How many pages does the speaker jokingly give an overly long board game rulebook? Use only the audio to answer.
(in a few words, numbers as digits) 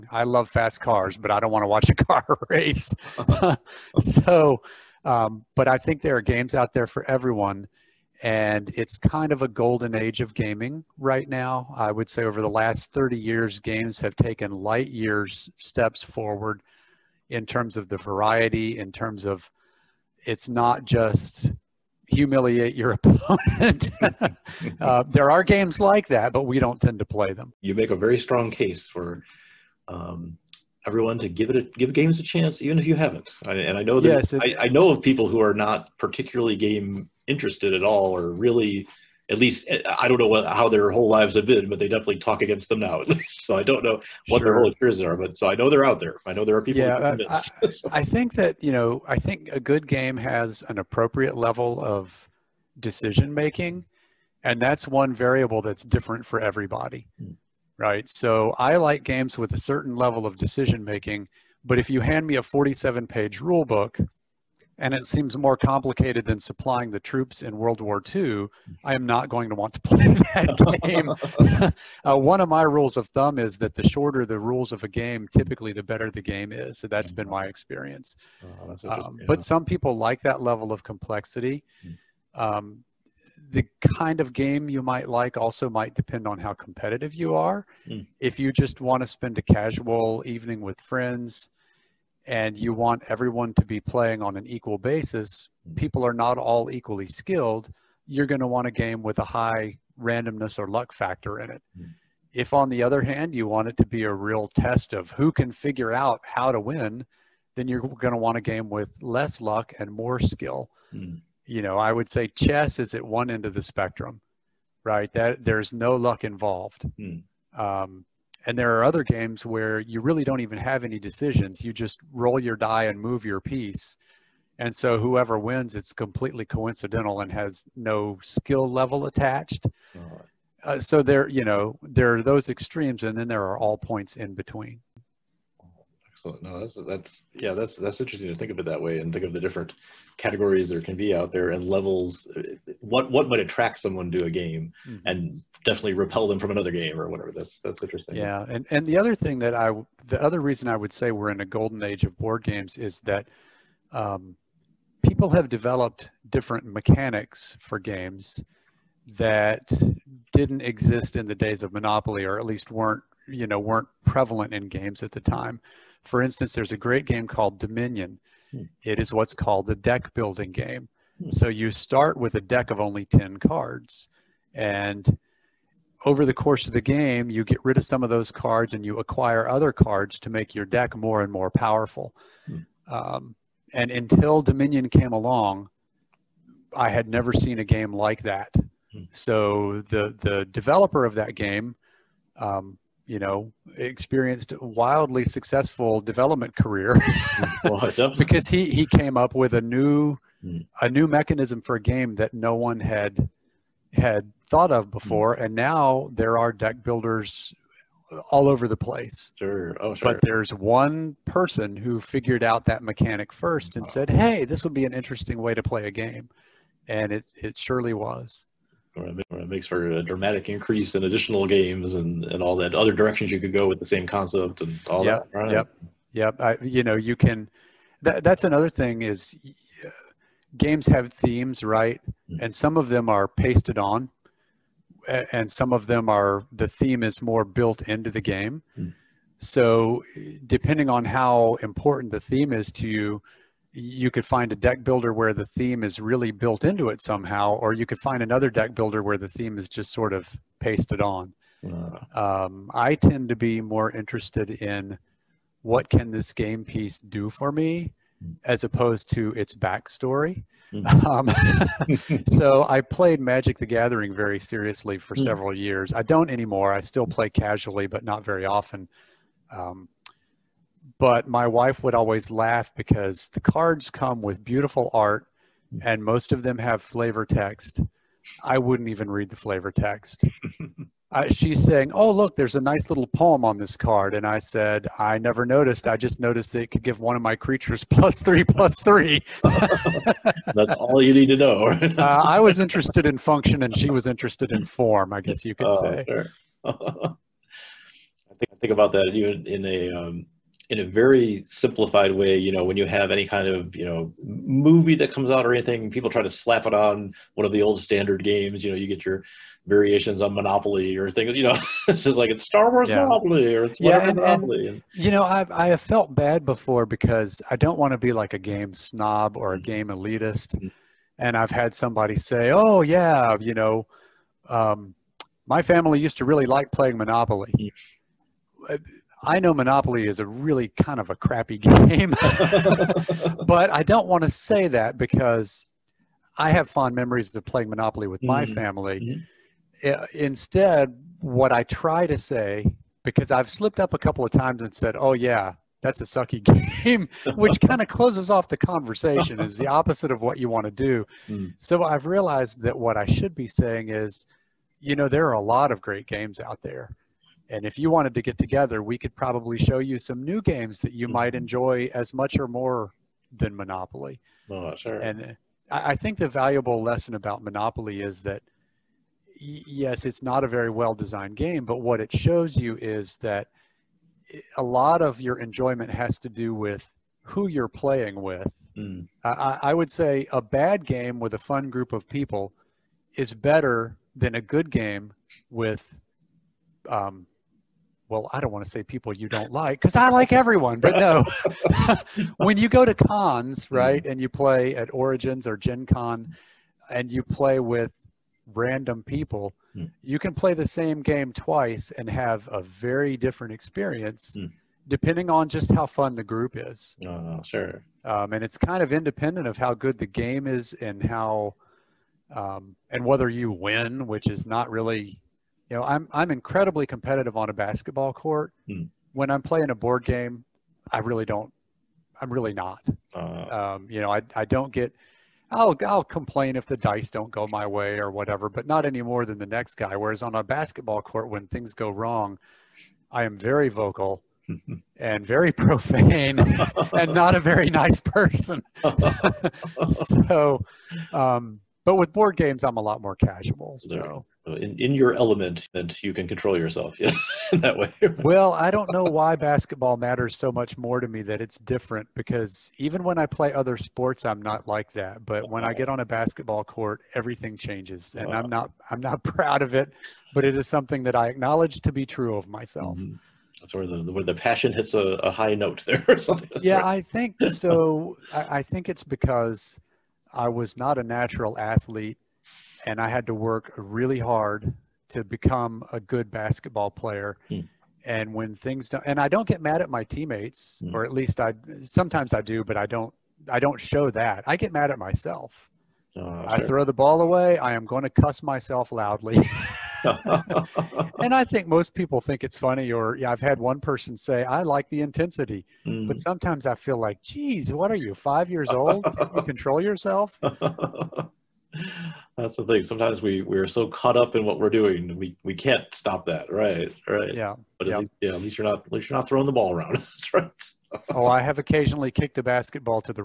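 47.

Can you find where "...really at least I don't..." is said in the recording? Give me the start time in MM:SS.
00:38.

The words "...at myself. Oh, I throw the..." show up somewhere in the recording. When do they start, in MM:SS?
08:04.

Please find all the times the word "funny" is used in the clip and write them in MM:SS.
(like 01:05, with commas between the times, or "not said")
08:12.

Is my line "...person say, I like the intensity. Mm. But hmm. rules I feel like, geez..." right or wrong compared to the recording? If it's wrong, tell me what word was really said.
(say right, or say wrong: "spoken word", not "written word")
wrong: "sometimes", not "rules".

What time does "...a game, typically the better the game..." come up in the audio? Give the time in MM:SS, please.
01:14.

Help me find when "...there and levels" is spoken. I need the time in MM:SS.
02:21.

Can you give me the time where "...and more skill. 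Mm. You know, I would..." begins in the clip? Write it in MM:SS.
01:49.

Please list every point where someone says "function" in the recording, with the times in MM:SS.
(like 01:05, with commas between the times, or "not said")
04:53.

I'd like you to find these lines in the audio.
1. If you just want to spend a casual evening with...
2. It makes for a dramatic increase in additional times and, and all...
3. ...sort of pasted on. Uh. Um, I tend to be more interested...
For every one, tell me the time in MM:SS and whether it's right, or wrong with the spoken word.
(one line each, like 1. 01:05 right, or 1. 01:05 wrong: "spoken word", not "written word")
1. 01:28 right
2. 03:39 wrong: "games", not "times"
3. 04:09 right.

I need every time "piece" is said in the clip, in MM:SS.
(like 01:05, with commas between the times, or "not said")
02:03, 04:16.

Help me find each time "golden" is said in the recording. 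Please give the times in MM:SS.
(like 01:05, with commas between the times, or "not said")
00:09, 02:31.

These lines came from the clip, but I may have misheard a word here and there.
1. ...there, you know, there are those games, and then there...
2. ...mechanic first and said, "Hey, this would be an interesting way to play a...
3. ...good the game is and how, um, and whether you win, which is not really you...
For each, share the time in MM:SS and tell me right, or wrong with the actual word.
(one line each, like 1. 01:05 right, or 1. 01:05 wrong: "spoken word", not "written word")
1. 02:11 wrong: "extremes", not "games"
2. 03:32 right
3. 06:49 right.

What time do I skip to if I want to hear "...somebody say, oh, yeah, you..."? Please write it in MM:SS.
05:21.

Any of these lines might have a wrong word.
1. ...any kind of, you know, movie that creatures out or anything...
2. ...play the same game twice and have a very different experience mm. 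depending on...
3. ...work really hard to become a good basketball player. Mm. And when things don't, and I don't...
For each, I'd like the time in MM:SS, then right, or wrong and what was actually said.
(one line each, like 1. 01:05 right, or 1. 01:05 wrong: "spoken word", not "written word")
1. 05:03 wrong: "comes", not "creatures"
2. 06:40 right
3. 07:53 right.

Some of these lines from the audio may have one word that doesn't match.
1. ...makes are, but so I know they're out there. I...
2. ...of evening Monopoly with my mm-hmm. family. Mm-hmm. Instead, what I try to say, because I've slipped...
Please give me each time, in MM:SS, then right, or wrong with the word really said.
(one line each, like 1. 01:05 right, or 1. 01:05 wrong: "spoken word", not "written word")
1. 00:44 wrong: "experiences", not "makes"
2. 05:37 wrong: "playing", not "evening".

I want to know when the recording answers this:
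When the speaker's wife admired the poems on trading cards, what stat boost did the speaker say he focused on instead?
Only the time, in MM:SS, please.
04:47.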